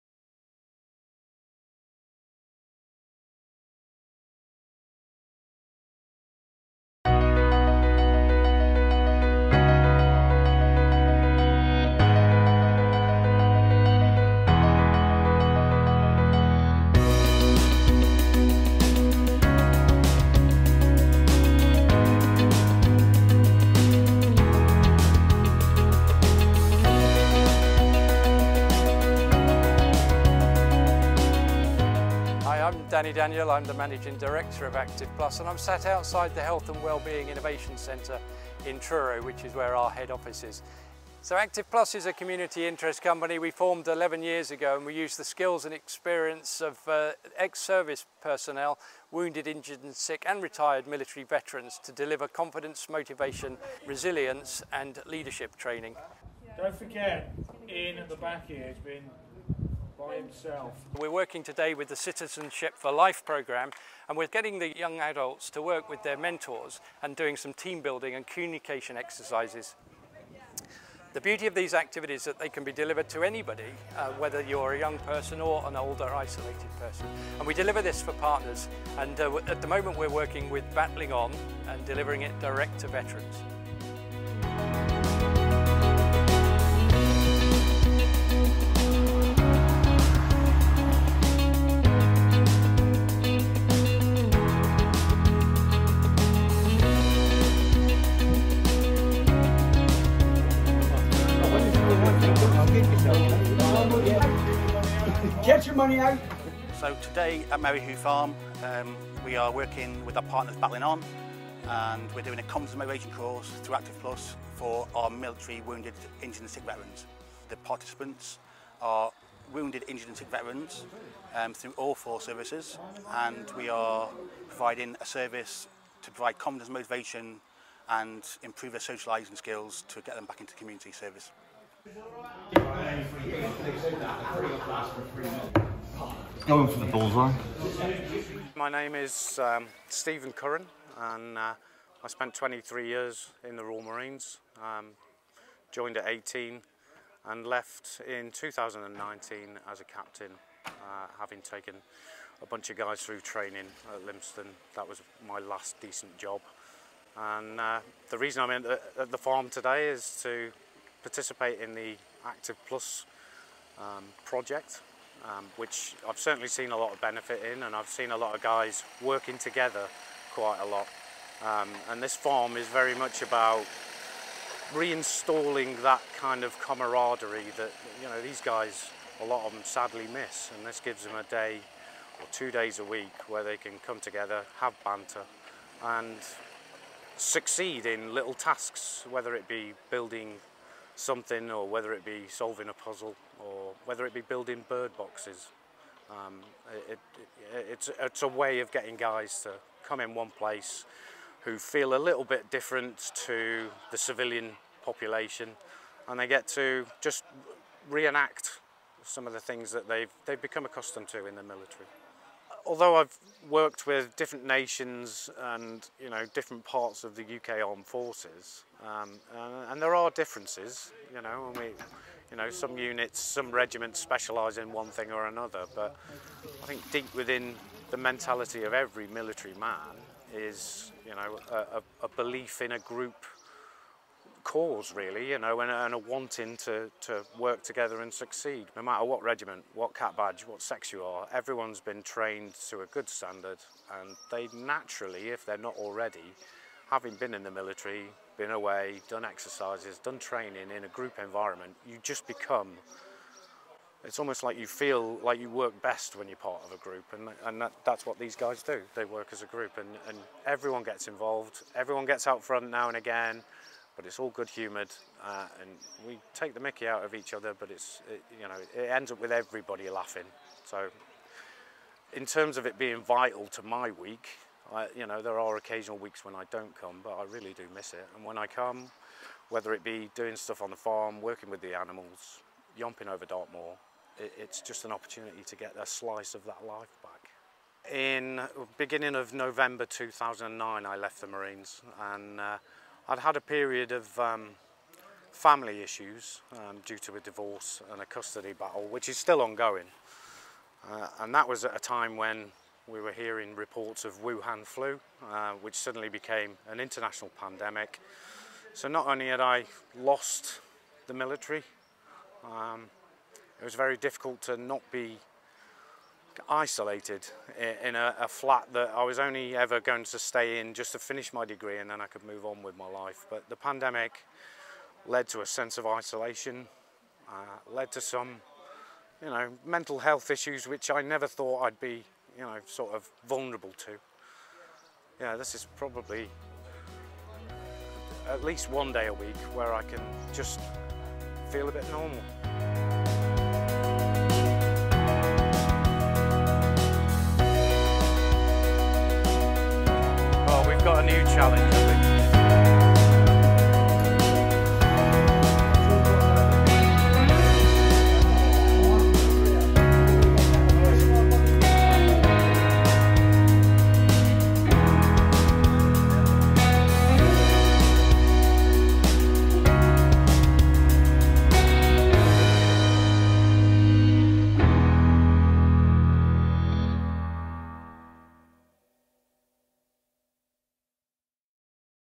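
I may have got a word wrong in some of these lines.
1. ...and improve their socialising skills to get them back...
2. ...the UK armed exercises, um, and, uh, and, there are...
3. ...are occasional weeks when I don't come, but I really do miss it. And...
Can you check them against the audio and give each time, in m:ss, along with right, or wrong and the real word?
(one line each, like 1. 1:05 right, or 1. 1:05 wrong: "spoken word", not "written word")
1. 2:07 right
2. 3:37 wrong: "forces", not "exercises"
3. 4:35 right.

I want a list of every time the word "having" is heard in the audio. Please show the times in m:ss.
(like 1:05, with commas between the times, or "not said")
2:31, 4:06.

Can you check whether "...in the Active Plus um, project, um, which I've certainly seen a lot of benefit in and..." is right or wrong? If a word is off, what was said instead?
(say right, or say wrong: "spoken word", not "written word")
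right.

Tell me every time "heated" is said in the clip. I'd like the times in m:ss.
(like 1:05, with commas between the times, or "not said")
not said.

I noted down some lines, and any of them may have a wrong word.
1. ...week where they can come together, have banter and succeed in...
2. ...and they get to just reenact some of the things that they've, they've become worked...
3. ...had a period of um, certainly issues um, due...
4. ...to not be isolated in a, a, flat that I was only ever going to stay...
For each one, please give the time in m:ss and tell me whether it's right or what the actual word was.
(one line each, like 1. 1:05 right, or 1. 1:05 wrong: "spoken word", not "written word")
1. 3:02 right
2. 3:26 wrong: "accustomed", not "worked"
3. 4:53 wrong: "family", not "certainly"
4. 5:14 right.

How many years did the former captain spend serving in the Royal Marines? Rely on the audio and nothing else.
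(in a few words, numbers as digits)
23.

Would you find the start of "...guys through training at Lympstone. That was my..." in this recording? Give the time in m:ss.
2:32.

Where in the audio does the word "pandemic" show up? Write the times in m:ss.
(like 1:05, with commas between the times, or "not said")
5:07, 5:23.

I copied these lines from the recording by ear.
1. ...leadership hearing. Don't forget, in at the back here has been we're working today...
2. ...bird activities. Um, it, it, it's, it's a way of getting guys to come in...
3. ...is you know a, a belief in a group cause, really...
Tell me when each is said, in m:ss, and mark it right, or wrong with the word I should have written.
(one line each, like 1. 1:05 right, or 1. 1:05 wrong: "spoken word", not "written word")
1. 0:55 wrong: "training", not "hearing"
2. 3:14 wrong: "boxes", not "activities"
3. 3:50 right.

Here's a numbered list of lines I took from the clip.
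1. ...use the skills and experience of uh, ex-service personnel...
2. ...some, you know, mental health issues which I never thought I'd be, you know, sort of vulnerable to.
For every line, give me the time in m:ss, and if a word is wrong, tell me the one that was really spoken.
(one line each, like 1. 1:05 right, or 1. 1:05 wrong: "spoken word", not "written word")
1. 0:44 right
2. 5:28 right.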